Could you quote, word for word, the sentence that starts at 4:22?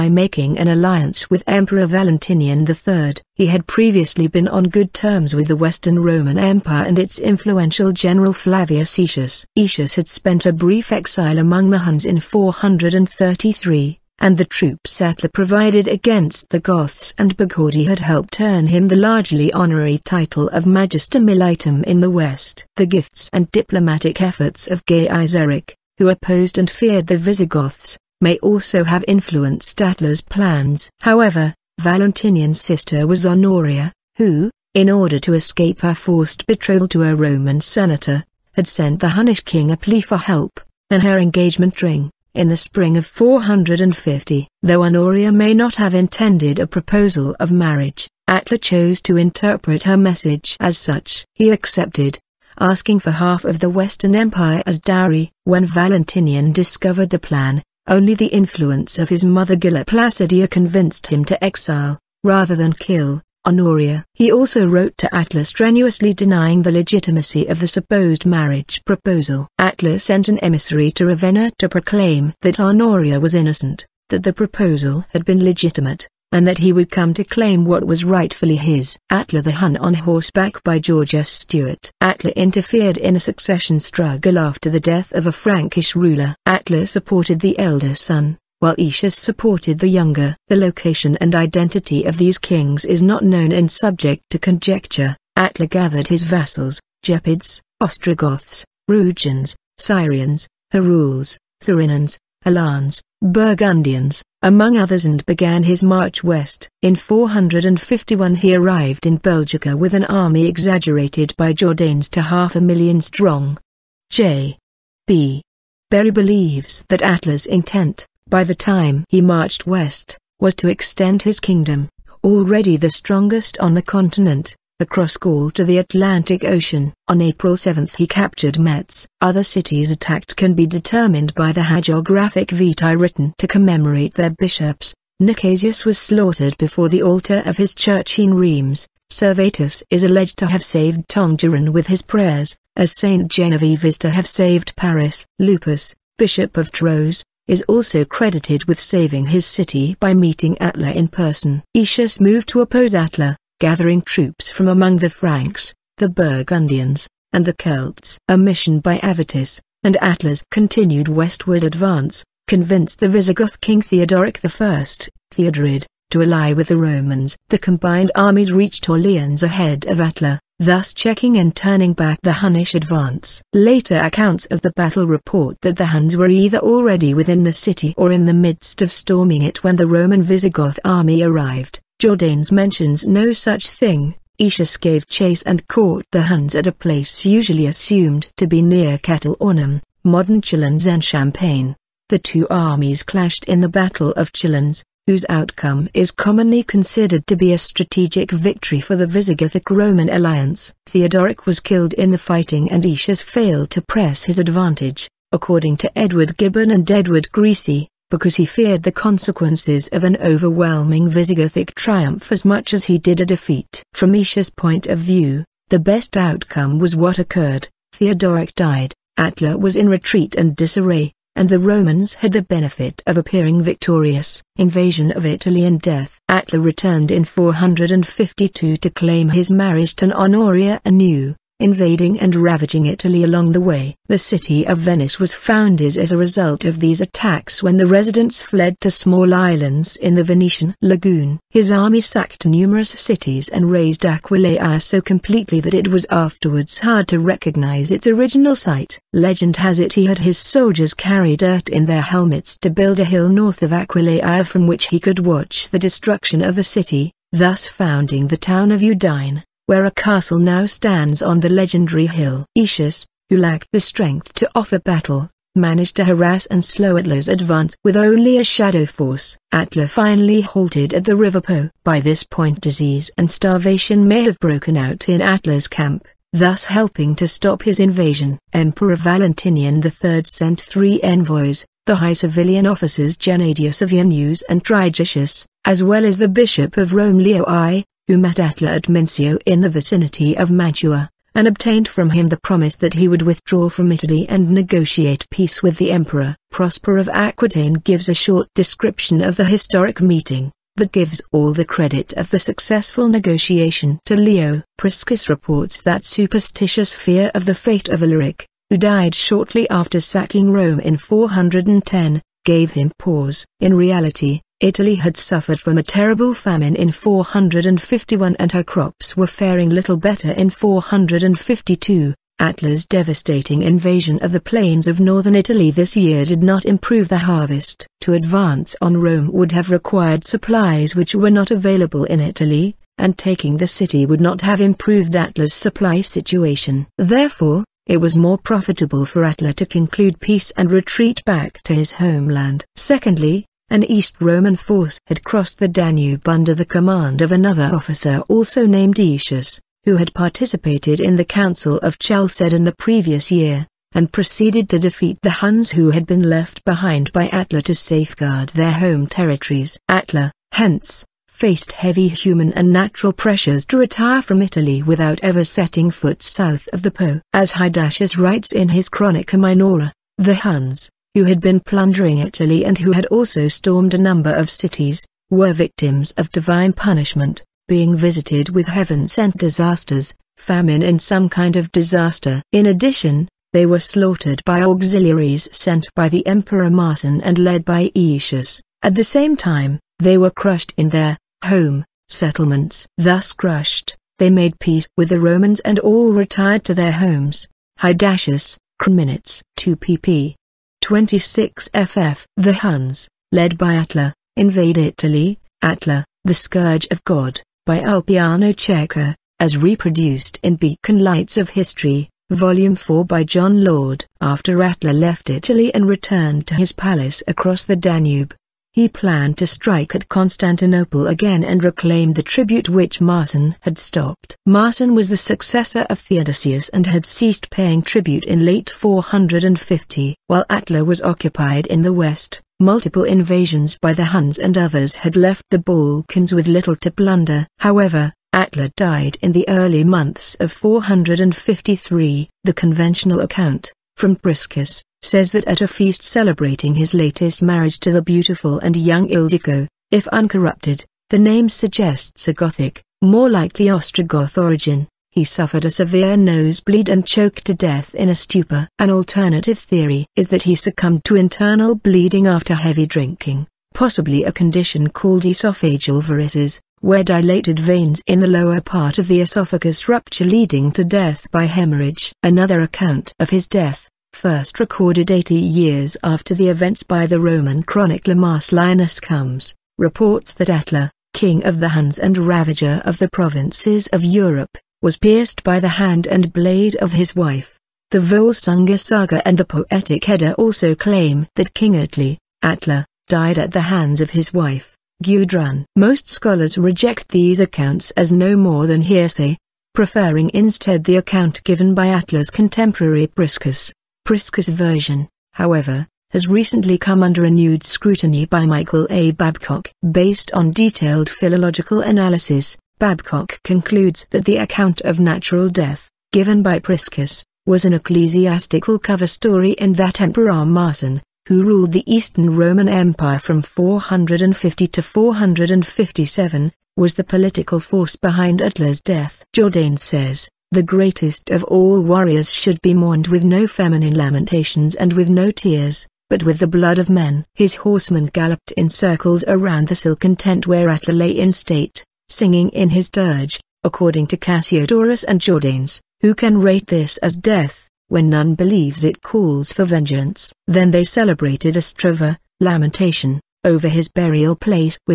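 Aetius, who lacked the strength to offer battle, managed to harass and slow Attila's advance with only a shadow force.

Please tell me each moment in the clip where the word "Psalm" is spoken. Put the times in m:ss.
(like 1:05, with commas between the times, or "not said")
not said.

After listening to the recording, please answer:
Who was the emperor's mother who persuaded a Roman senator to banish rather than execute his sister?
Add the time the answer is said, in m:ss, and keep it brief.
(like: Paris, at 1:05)
Galla Placidia, at 0:59.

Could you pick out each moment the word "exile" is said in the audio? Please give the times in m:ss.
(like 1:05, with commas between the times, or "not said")
0:10, 1:01.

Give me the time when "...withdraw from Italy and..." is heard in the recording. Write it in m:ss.
4:53.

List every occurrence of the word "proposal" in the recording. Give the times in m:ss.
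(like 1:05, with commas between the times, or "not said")
0:46, 1:08, 1:14.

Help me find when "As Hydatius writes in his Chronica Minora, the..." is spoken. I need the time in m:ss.
6:07.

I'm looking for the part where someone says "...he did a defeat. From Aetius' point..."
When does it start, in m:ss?
3:32.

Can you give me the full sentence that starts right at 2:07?
On April 7 he captured Metz.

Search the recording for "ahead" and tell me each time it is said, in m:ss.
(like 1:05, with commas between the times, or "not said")
2:49.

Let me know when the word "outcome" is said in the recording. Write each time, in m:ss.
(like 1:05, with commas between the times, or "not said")
3:15, 3:36.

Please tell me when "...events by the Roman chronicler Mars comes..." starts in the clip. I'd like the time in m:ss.
7:56.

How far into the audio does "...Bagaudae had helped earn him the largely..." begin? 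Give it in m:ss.
0:17.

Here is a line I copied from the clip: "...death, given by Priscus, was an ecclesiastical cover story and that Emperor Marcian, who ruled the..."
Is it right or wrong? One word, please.
right.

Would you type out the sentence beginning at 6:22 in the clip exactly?
In addition, they were slaughtered by auxiliaries sent by the Emperor Marcian and led by Aetius.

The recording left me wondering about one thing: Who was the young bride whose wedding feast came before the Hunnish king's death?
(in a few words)
Ildiko.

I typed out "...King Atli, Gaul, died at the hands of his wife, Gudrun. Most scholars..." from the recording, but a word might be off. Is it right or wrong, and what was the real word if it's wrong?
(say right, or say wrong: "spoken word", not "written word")
wrong: "Attila", not "Gaul".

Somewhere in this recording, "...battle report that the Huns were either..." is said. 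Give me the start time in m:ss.
2:54.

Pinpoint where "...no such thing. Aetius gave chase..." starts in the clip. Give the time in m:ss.
3:03.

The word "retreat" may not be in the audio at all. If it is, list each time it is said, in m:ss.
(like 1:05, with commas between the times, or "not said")
3:39, 5:40.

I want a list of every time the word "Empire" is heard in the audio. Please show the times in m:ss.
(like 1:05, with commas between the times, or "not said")
0:06, 0:54, 8:42.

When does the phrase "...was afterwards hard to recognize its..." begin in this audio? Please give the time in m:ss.
4:05.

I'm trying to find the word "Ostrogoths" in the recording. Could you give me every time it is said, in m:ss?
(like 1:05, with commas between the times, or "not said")
1:37, 7:33.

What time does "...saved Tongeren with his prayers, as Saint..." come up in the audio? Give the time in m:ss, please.
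2:20.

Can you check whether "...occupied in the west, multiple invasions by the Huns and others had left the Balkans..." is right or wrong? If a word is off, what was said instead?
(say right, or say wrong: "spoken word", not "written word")
right.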